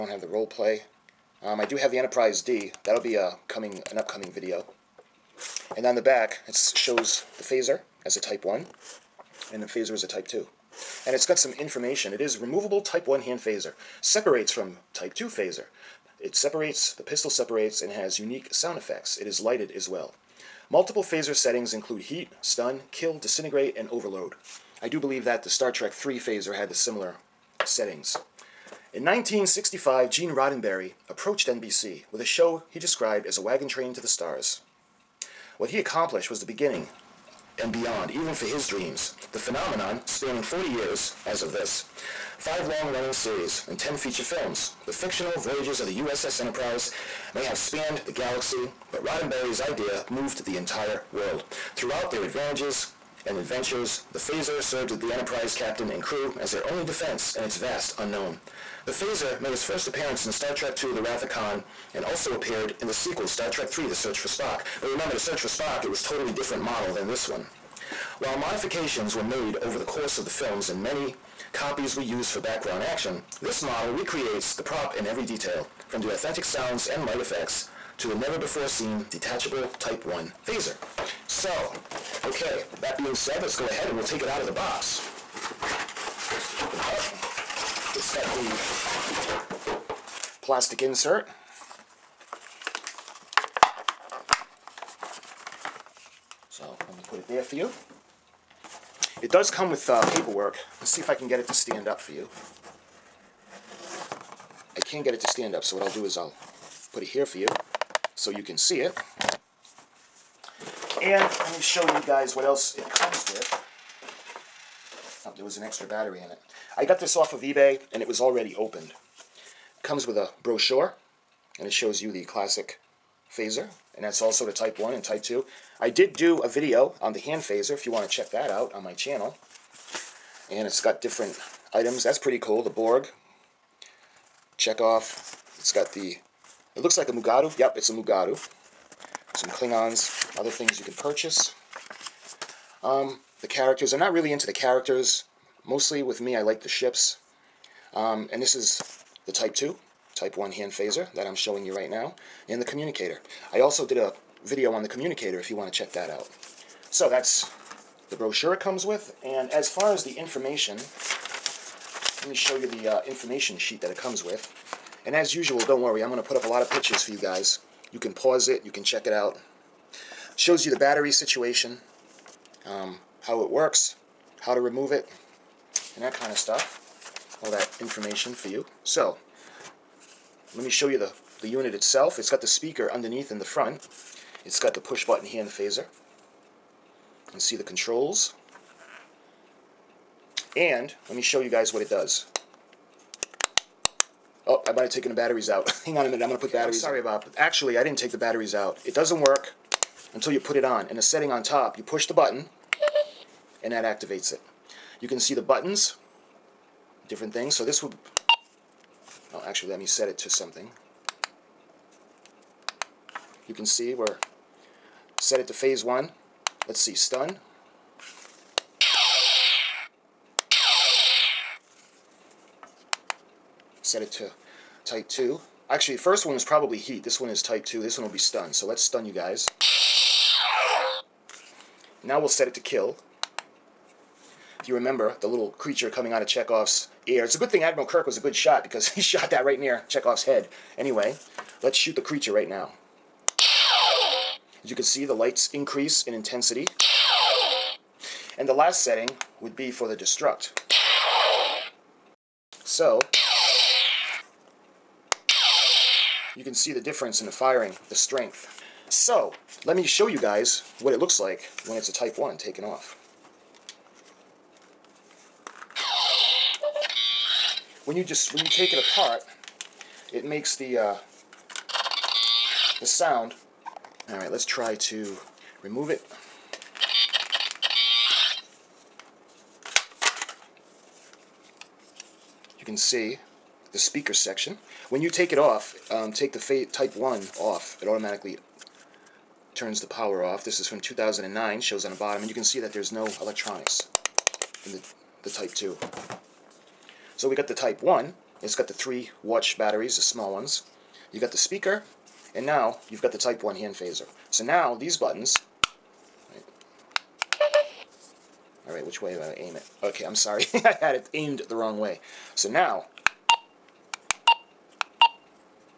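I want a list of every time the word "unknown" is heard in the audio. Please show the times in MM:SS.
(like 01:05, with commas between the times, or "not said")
00:57.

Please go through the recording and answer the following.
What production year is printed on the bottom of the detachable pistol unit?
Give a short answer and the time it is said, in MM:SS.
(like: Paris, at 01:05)
2009, at 04:50.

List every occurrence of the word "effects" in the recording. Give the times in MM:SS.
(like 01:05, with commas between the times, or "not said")
00:18, 01:17.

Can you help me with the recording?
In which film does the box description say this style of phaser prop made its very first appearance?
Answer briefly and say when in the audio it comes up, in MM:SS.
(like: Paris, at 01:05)
Star Trek II The Wrath of Khan, at 01:00.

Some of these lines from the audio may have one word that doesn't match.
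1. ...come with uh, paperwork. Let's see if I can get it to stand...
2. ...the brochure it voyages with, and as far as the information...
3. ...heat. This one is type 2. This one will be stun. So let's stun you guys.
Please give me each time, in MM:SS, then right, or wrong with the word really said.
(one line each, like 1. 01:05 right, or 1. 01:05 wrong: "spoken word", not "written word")
1. 01:39 right
2. 02:38 wrong: "comes", not "voyages"
3. 03:46 right.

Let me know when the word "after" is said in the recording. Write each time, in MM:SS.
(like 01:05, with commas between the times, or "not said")
not said.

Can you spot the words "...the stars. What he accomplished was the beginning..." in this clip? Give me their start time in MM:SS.
00:33.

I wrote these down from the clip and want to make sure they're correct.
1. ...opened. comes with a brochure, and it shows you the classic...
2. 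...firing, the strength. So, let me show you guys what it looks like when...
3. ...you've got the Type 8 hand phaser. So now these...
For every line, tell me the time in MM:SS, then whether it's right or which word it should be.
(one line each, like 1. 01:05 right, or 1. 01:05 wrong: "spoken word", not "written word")
1. 01:58 right
2. 04:17 right
3. 05:02 wrong: "1", not "8".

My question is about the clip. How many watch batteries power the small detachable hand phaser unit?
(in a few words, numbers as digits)
3.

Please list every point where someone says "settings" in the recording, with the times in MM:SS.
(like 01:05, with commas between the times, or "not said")
00:21, 00:27, 03:21, 04:08.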